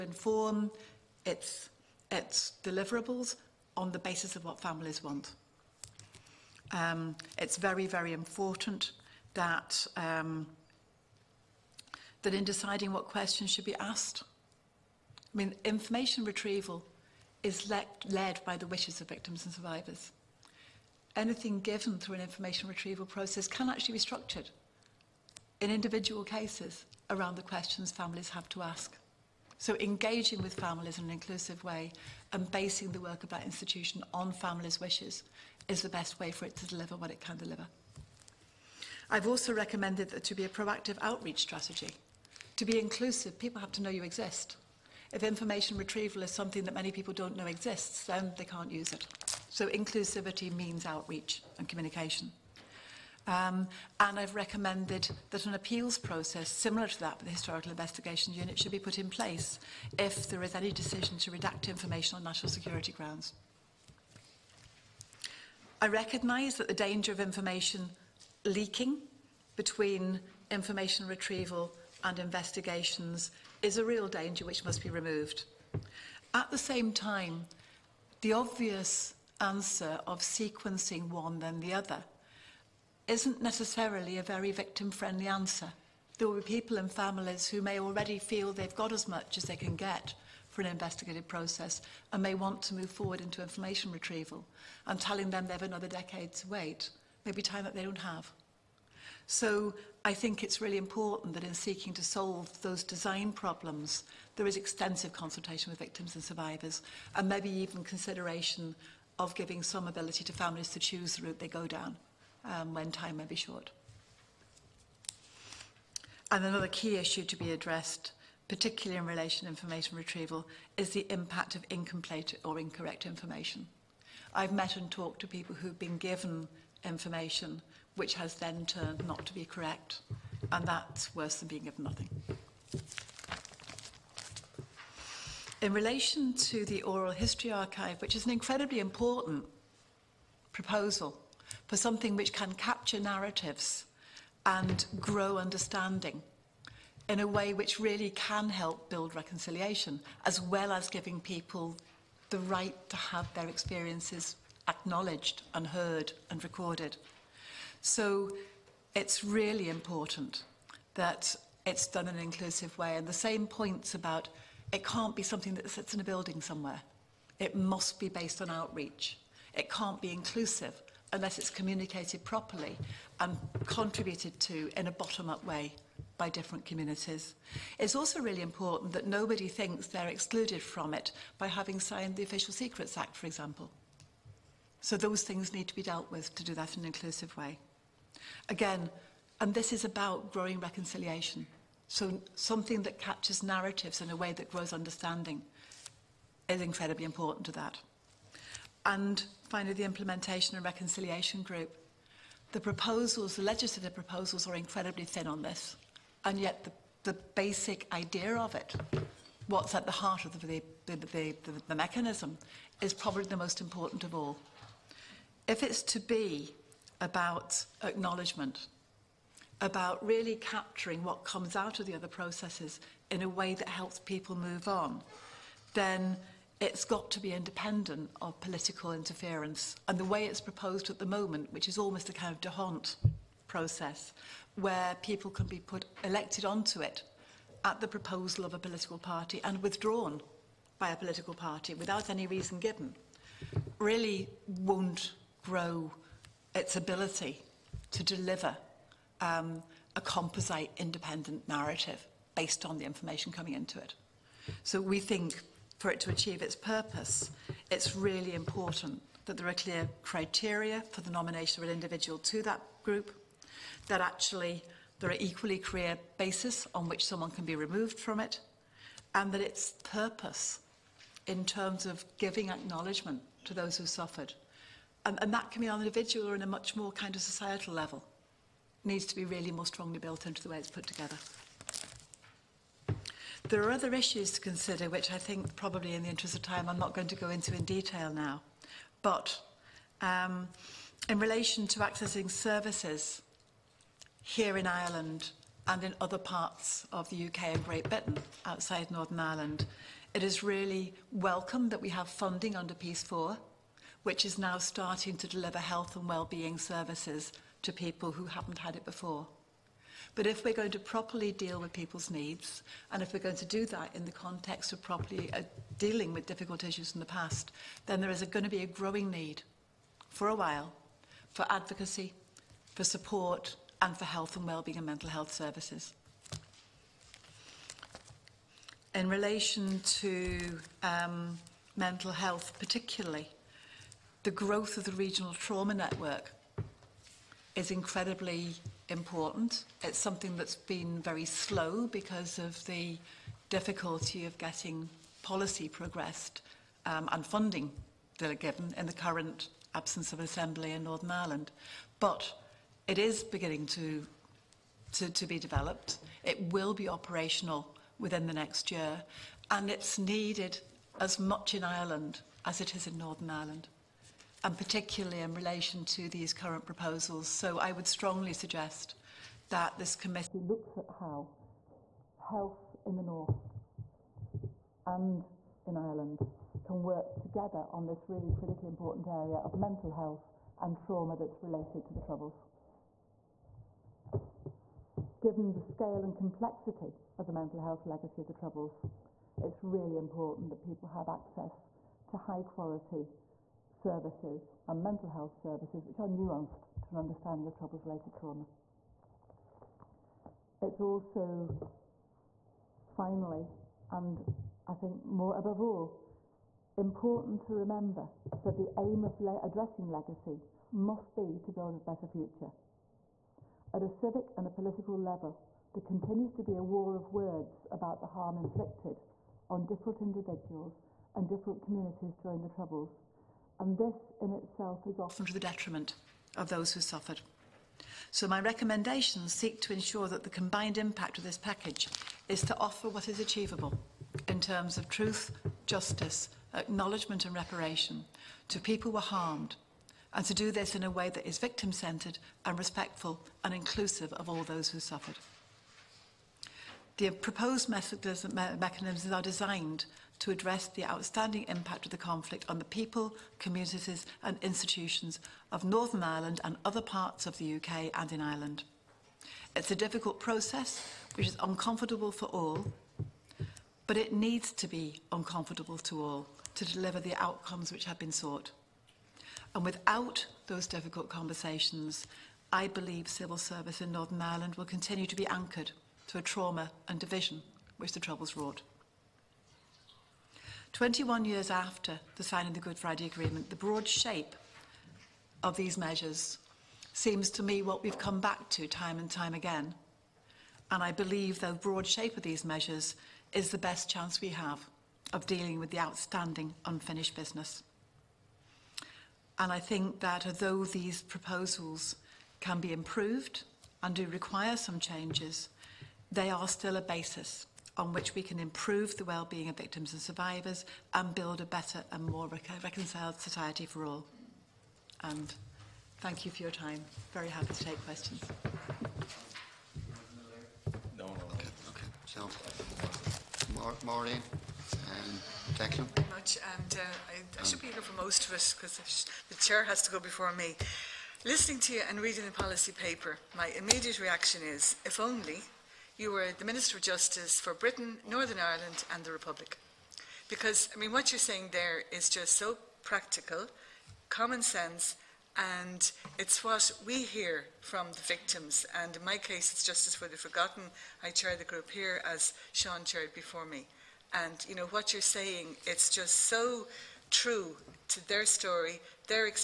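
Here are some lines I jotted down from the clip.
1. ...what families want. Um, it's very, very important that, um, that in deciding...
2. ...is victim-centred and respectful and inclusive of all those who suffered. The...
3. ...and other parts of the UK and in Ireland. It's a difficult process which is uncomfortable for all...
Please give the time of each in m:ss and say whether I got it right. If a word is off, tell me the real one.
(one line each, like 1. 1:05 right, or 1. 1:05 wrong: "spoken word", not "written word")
1. 0:04 right
2. 7:21 right
3. 7:36 right.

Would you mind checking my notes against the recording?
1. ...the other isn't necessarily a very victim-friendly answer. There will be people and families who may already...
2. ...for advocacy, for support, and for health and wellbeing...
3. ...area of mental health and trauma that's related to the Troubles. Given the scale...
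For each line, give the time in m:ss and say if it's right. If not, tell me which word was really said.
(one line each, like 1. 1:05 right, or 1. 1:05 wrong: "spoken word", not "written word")
1. 1:21 right
2. 5:21 right
3. 6:19 right.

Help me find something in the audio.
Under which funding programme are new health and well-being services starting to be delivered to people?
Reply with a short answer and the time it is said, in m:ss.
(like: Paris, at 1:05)
Peace 4, at 5:02.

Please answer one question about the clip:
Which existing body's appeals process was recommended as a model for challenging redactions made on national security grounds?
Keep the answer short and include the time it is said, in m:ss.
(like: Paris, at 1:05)
Historical Investigation Unit, at 0:57.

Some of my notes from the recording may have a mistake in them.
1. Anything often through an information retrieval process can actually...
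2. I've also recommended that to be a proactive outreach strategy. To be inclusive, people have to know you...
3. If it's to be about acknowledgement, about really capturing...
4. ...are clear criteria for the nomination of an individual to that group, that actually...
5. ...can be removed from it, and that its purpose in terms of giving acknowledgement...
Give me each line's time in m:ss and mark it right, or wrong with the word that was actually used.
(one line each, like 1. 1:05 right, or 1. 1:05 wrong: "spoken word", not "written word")
1. 0:21 wrong: "given", not "often"
2. 0:39 right
3. 3:35 right
4. 4:19 right
5. 4:27 right.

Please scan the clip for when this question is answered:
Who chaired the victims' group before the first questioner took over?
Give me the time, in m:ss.
9:12.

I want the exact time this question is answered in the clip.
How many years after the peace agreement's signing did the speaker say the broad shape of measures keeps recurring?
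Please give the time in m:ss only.
8:00.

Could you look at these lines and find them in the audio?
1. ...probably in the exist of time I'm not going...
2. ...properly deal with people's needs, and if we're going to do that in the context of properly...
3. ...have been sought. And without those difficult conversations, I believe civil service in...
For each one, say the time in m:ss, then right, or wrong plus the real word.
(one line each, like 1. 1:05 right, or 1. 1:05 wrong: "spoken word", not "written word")
1. 4:45 wrong: "interest", not "exist"
2. 5:10 right
3. 7:47 right.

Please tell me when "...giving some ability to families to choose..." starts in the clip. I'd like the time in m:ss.
1:49.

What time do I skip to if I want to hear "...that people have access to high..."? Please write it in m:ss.
6:30.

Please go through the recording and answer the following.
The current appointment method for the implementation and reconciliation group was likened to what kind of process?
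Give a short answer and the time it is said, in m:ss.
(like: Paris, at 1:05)
d'Hondt, at 3:52.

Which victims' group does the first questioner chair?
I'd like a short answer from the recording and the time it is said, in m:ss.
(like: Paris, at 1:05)
Justice for the Forgotten, at 9:09.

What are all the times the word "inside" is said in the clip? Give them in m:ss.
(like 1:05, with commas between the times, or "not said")
not said.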